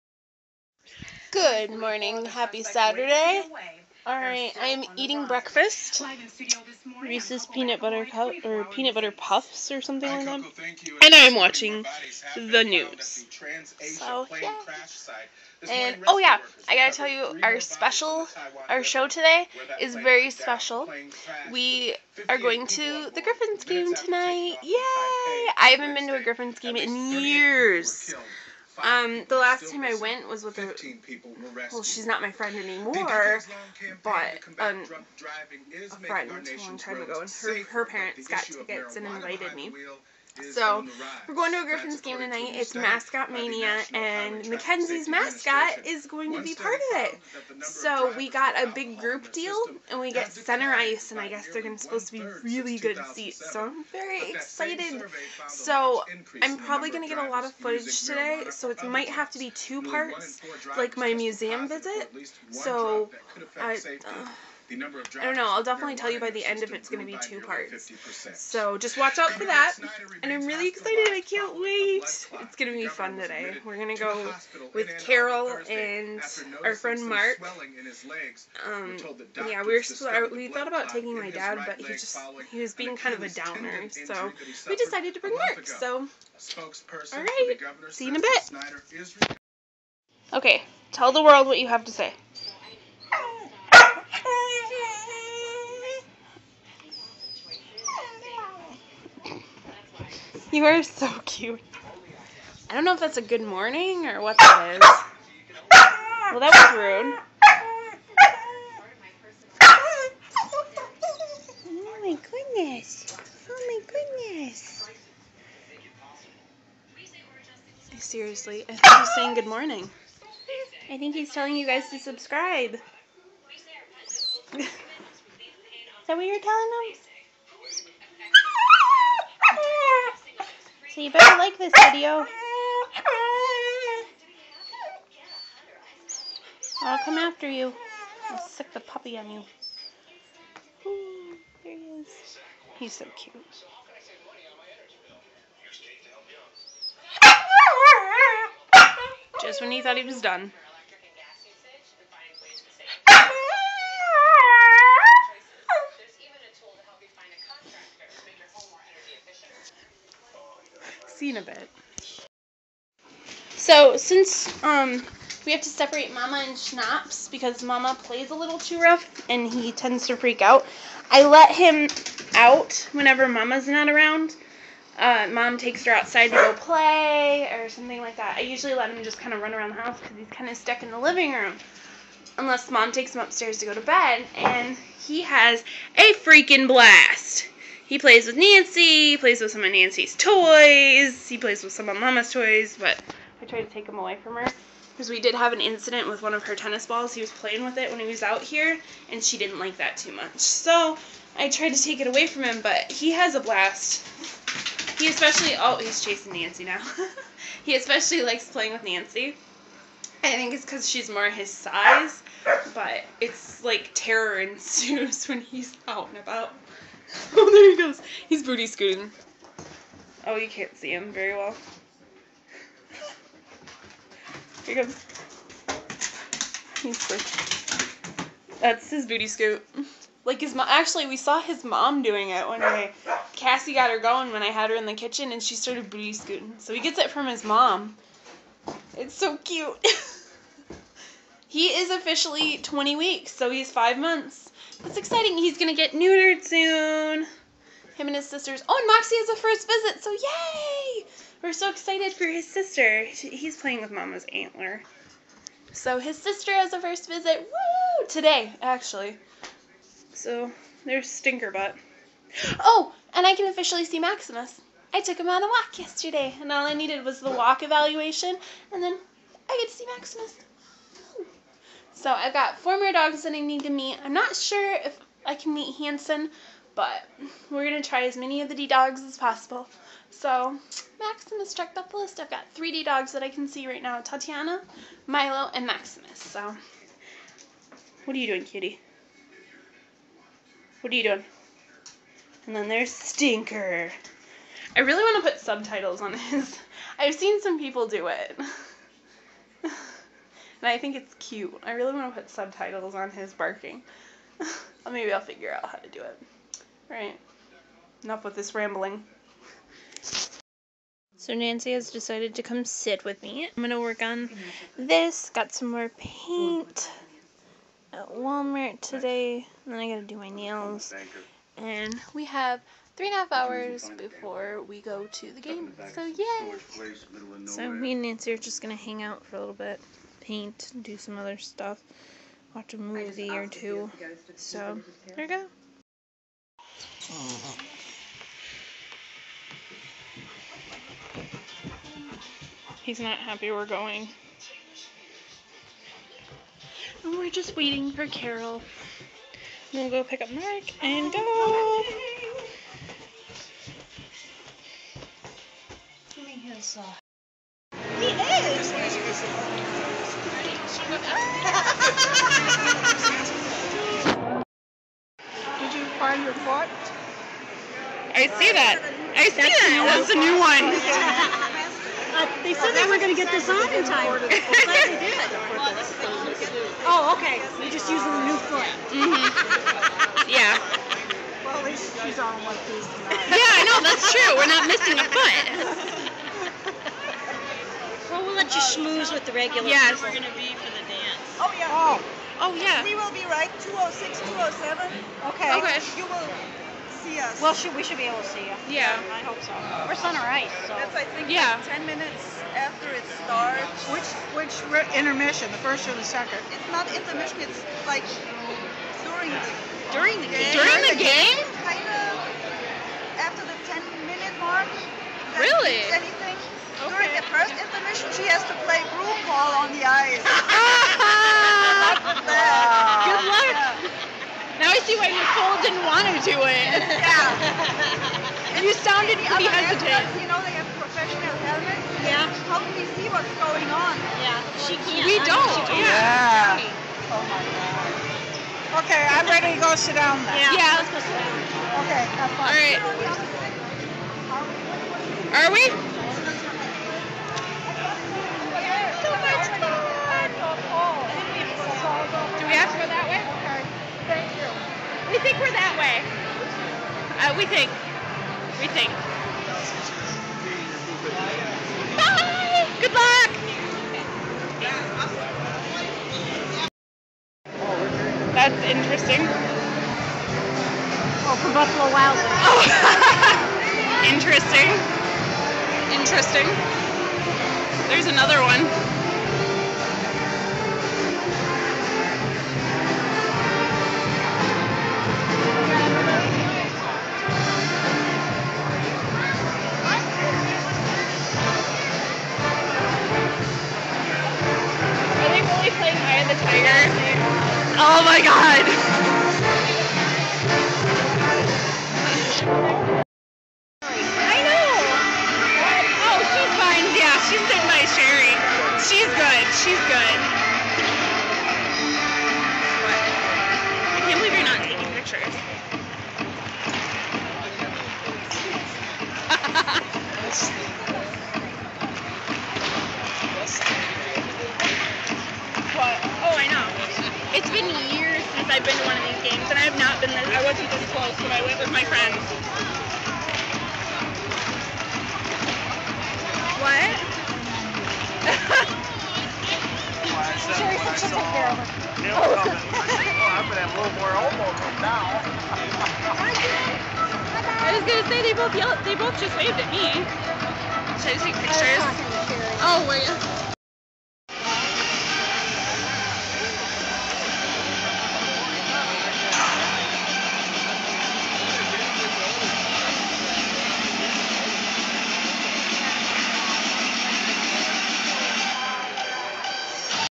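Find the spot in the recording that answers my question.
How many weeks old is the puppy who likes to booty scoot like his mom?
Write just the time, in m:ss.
4:02.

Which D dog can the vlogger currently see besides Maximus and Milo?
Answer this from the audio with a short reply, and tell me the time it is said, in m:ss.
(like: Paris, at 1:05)
Tatiana, at 4:44.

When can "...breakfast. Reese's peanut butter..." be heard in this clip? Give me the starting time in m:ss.
0:05.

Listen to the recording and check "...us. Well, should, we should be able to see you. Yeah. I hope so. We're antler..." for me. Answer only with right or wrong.
wrong.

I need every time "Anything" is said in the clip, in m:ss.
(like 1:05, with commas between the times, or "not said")
6:55.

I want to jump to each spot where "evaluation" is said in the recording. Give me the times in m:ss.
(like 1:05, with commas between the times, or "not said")
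4:27.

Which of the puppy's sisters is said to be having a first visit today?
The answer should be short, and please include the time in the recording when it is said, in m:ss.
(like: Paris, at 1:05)
Moxie, at 4:08.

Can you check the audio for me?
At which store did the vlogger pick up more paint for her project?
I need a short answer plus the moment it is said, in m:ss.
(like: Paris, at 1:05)
Walmart, at 5:18.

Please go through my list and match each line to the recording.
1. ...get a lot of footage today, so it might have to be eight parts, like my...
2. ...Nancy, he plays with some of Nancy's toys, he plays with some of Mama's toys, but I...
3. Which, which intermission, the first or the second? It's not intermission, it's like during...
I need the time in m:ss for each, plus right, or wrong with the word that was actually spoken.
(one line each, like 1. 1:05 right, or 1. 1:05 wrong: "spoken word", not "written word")
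1. 0:57 wrong: "two", not "eight"
2. 3:08 right
3. 6:43 right.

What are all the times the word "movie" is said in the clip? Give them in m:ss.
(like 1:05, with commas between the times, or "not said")
5:32.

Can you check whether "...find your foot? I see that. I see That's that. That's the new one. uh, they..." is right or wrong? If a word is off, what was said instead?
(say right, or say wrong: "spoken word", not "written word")
right.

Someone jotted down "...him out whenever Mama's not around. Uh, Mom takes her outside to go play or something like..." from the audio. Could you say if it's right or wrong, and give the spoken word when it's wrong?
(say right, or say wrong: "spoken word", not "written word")
right.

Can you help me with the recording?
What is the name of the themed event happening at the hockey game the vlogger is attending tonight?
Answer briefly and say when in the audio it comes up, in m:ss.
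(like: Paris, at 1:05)
Mascot Mania, at 0:42.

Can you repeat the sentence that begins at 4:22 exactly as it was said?
Oh, and I can officially see Maximus.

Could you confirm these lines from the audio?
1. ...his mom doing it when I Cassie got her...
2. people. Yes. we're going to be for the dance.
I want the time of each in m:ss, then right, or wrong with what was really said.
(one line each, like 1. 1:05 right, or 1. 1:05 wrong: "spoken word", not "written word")
1. 3:51 right
2. 6:29 right.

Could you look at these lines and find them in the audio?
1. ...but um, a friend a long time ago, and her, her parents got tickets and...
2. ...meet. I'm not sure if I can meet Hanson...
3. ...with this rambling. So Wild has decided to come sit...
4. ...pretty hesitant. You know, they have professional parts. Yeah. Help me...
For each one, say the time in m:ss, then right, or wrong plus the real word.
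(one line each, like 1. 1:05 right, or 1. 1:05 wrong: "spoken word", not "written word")
1. 0:34 right
2. 4:33 right
3. 5:08 wrong: "Nancy", not "Wild"
4. 7:09 wrong: "helmets", not "parts".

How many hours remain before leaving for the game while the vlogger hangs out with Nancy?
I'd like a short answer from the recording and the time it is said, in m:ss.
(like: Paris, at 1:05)
3.5, at 5:22.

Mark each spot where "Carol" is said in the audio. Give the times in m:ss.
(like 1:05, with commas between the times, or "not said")
1:15, 5:48.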